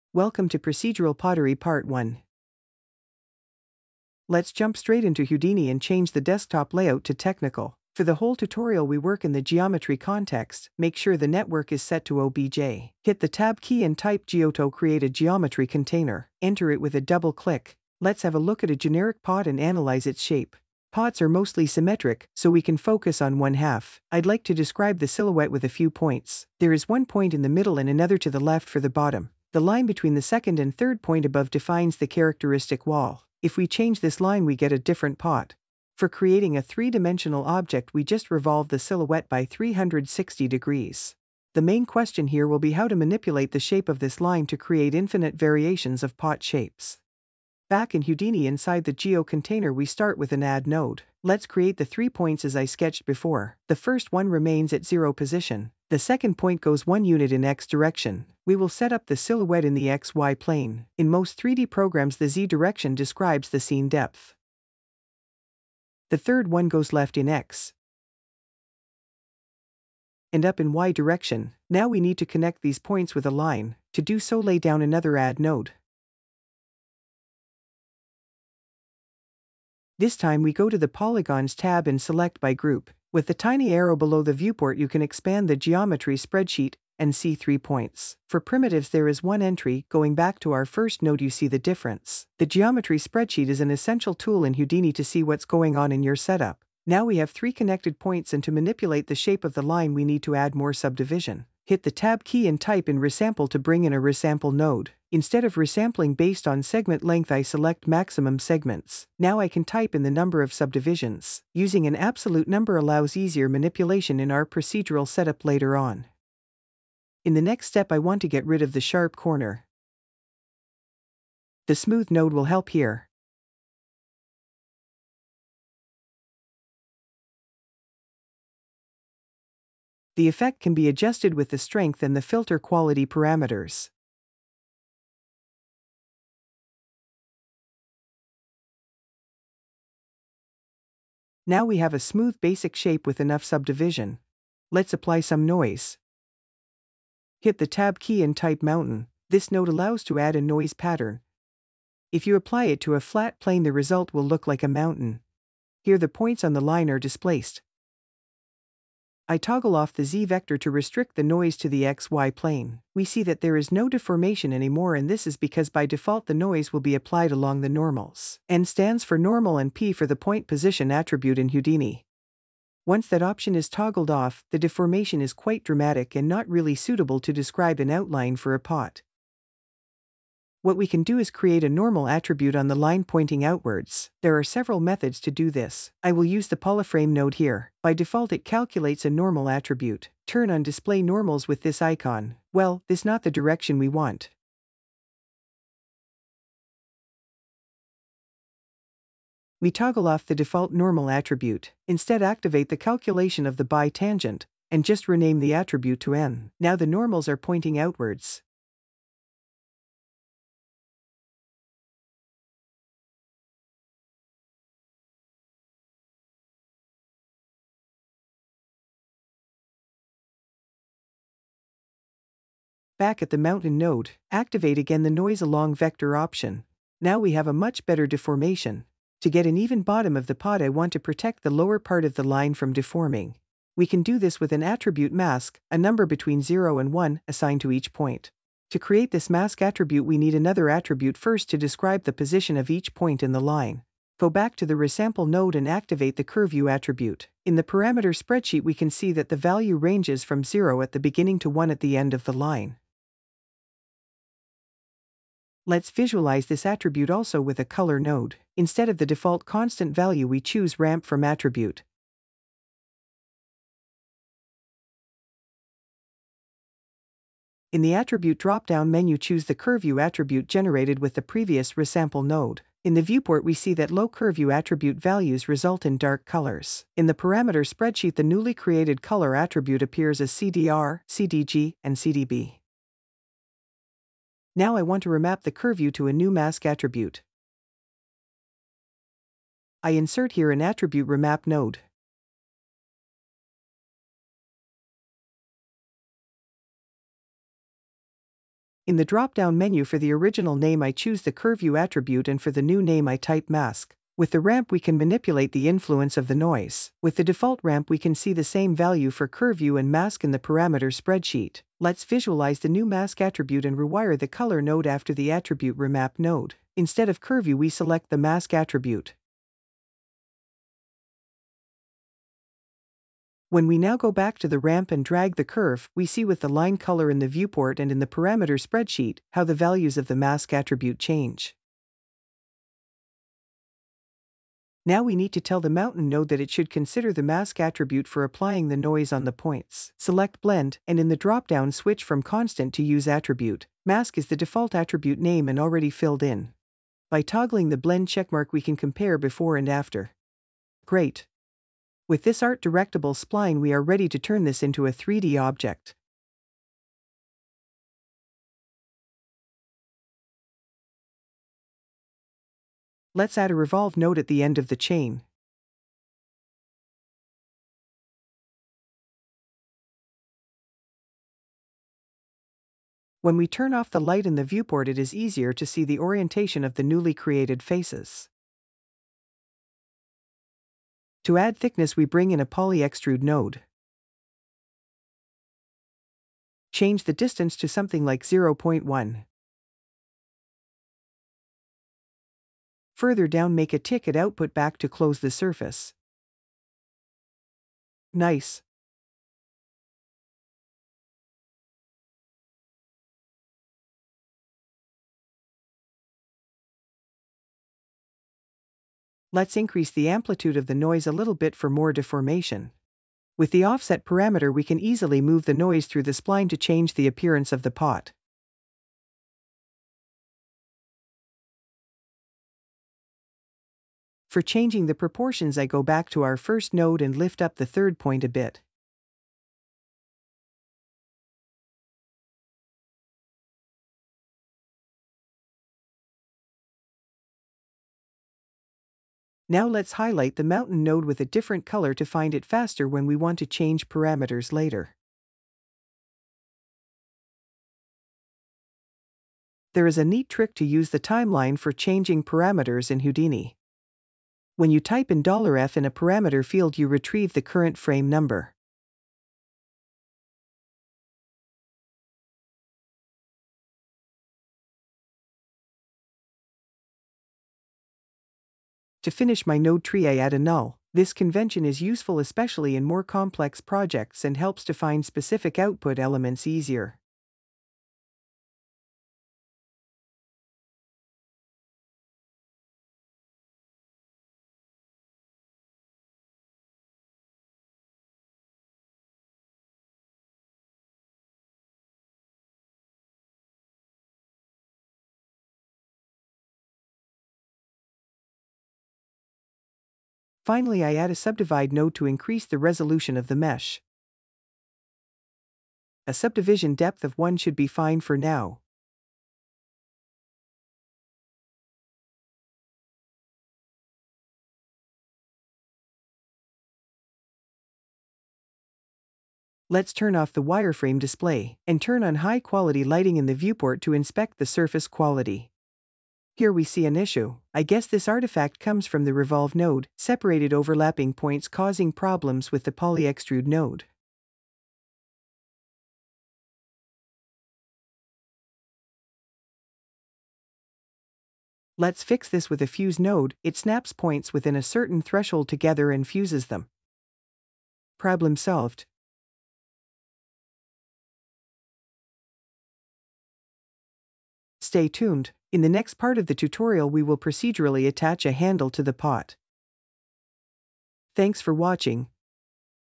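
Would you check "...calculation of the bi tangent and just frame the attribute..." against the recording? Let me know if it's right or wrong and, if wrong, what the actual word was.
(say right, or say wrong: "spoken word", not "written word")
wrong: "rename", not "frame".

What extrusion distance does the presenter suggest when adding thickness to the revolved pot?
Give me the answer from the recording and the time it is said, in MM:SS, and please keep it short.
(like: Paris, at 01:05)
0.1, at 06:28.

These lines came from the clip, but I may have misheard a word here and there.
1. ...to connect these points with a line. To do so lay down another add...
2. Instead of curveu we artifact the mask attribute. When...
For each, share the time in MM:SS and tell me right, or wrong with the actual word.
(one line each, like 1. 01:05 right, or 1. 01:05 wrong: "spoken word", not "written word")
1. 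01:12 right
2. 05:16 wrong: "select", not "artifact".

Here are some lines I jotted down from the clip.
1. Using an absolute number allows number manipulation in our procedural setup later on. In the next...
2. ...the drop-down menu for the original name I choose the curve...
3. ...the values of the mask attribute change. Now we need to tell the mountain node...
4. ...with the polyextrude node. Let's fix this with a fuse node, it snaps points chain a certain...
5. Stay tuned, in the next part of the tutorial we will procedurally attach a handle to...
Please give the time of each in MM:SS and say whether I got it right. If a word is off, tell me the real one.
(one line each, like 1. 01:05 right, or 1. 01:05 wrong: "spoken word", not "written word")
1. 01:51 wrong: "easier", not "number"
2. 04:58 right
3. 05:29 right
4. 08:52 wrong: "within", not "chain"
5. 09:14 right.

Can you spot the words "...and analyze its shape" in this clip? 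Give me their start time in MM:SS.
00:19.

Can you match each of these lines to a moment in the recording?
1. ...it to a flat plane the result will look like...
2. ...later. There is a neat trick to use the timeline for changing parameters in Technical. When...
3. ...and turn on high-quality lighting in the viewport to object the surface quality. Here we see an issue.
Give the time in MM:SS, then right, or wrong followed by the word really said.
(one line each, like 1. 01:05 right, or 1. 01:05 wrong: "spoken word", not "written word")
1. 02:32 right
2. 07:24 wrong: "Houdini", not "Technical"
3. 08:41 wrong: "inspect", not "object".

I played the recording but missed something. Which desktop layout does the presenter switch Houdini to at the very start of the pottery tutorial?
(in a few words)
Technical.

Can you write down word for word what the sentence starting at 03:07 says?
By default it calculates a normal attribute.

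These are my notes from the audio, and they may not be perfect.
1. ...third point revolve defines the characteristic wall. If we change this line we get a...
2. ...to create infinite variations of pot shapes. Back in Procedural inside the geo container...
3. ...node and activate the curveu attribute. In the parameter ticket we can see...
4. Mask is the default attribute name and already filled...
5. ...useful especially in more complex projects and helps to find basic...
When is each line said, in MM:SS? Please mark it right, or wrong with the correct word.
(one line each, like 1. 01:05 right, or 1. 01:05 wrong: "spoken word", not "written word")
1. 00:30 wrong: "above", not "revolve"
2. 00:44 wrong: "Houdini", not "Procedural"
3. 04:05 wrong: "spreadsheet", not "ticket"
4. 05:43 right
5. 07:51 wrong: "specific", not "basic".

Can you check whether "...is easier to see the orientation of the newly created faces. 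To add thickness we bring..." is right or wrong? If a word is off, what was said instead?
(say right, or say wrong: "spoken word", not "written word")
right.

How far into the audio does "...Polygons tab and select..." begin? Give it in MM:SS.
01:20.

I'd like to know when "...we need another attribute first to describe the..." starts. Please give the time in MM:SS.
04:00.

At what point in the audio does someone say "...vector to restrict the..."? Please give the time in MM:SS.
02:40.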